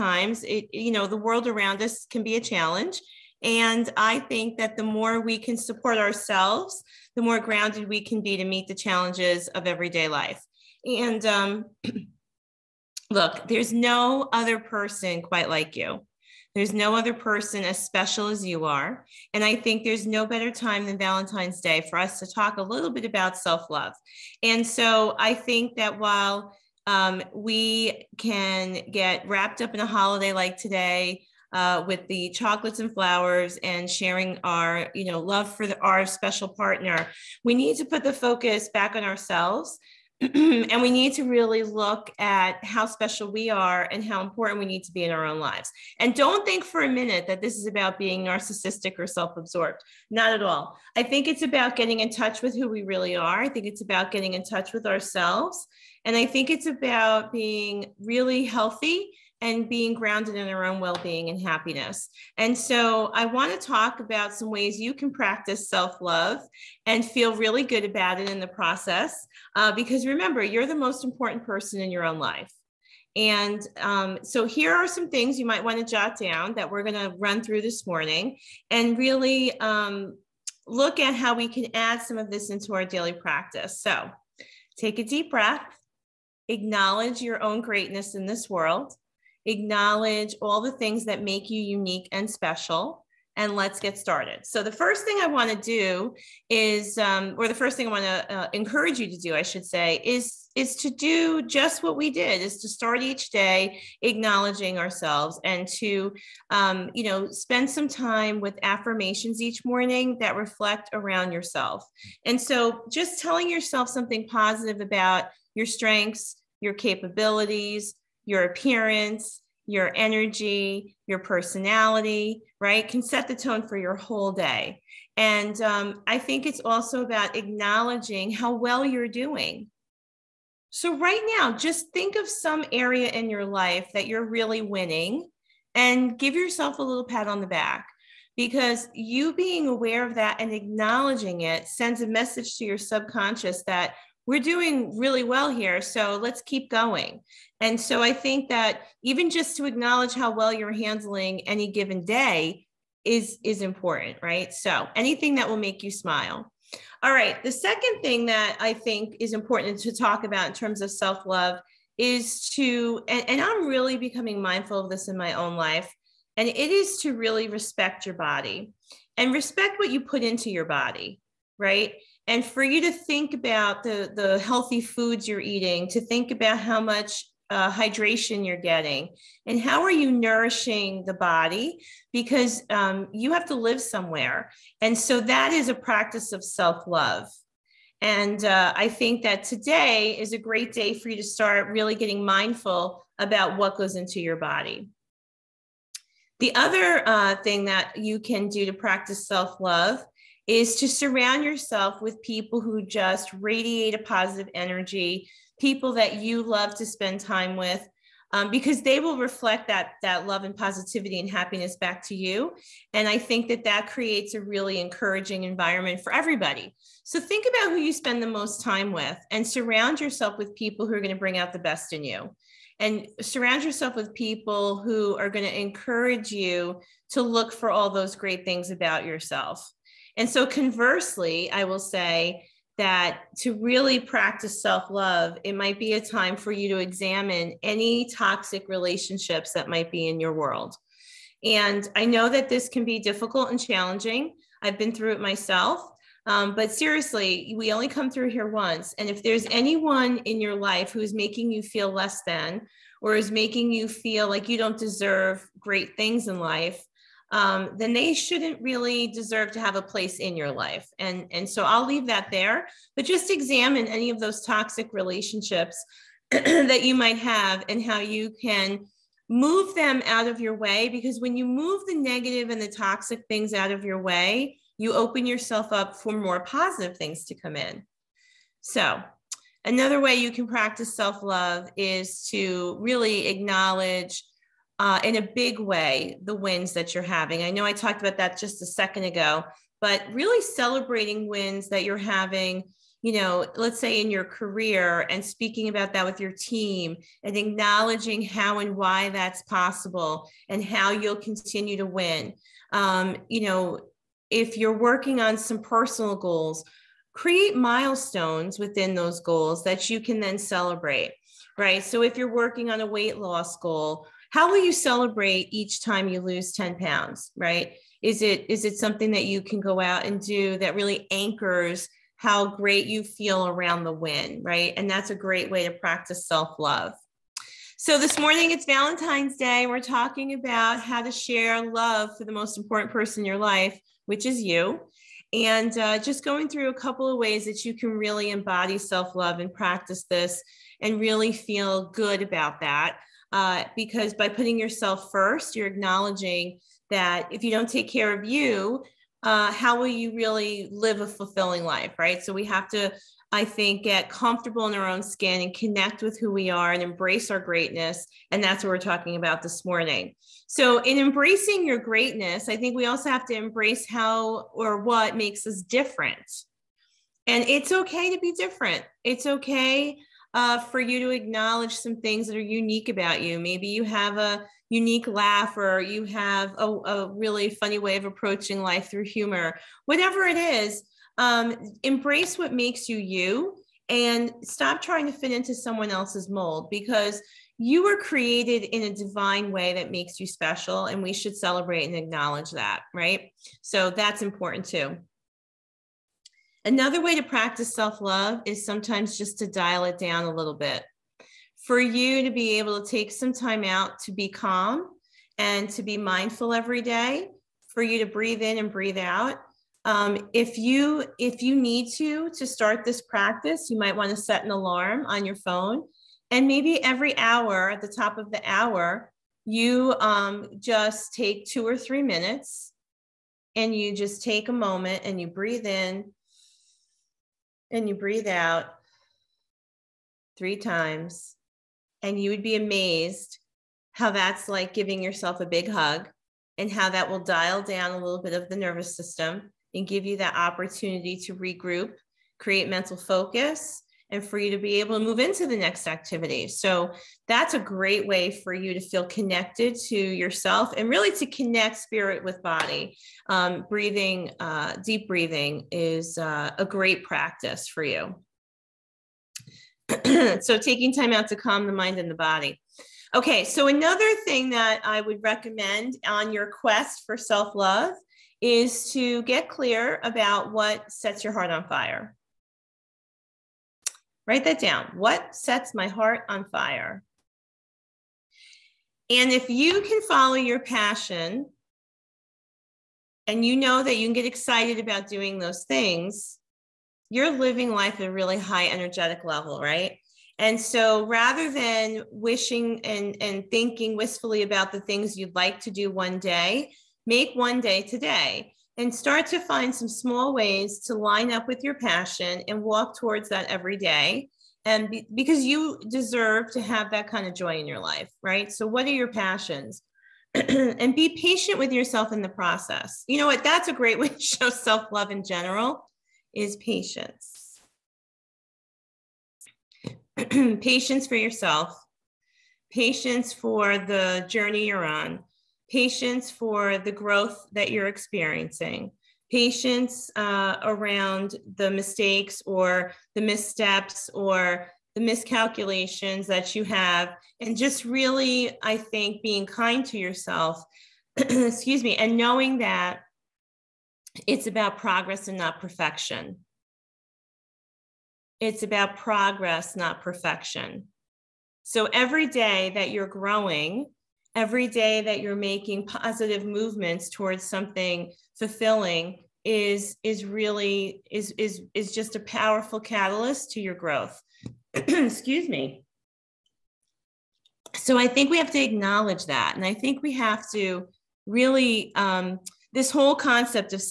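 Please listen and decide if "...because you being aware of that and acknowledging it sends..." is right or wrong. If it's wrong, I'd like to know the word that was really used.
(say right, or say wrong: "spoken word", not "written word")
right.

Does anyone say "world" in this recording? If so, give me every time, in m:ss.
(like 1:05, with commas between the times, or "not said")
0:01, 1:28, 4:00.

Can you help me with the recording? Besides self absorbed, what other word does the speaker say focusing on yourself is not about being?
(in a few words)
narcissistic.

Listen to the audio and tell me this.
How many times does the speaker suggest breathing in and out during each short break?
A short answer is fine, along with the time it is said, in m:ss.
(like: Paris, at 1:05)
3, at 7:10.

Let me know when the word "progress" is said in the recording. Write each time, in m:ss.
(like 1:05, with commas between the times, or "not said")
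9:04, 9:08.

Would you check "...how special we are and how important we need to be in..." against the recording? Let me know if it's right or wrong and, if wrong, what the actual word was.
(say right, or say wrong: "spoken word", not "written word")
right.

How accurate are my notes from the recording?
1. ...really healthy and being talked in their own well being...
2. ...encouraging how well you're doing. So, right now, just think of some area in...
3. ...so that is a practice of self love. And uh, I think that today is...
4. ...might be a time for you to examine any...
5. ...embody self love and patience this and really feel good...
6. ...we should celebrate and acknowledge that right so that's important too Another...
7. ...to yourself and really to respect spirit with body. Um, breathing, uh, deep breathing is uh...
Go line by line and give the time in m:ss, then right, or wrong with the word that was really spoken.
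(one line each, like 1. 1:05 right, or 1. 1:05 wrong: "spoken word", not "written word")
1. 0:58 wrong: "grounded", not "talked"
2. 2:07 wrong: "acknowledging", not "encouraging"
3. 3:04 right
4. 3:55 right
5. 5:38 wrong: "practice", not "patience"
6. 6:31 right
7. 7:29 wrong: "connect", not "respect".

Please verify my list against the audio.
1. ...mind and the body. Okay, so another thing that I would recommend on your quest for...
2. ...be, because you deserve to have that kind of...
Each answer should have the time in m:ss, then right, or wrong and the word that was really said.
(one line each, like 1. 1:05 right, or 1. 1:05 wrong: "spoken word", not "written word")
1. 7:41 right
2. 8:24 right.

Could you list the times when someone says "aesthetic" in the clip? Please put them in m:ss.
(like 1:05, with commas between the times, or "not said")
not said.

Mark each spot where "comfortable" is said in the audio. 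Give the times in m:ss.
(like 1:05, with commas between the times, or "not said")
5:54.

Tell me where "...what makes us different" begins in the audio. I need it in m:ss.
6:04.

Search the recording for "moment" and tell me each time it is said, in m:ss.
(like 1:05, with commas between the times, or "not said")
7:04.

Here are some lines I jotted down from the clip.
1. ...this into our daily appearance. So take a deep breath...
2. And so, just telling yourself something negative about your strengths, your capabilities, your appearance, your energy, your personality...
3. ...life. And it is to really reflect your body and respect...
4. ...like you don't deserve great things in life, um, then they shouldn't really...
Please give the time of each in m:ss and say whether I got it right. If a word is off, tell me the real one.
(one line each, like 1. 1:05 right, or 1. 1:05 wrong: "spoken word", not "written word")
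1. 1:22 wrong: "practice", not "appearance"
2. 1:52 wrong: "positive", not "negative"
3. 2:45 wrong: "respect", not "reflect"
4. 4:14 right.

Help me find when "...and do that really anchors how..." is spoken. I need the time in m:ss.
5:20.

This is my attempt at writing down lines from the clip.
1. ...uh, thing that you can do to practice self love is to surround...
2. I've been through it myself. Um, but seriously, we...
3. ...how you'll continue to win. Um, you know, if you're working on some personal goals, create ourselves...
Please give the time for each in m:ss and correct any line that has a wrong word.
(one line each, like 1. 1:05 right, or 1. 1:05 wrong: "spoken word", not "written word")
1. 3:17 right
2. 4:04 right
3. 5:00 wrong: "milestones", not "ourselves".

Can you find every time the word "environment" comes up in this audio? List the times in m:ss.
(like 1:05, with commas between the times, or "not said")
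3:35.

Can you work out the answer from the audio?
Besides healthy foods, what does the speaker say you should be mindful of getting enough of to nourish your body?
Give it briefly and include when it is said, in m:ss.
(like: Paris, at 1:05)
hydration, at 2:57.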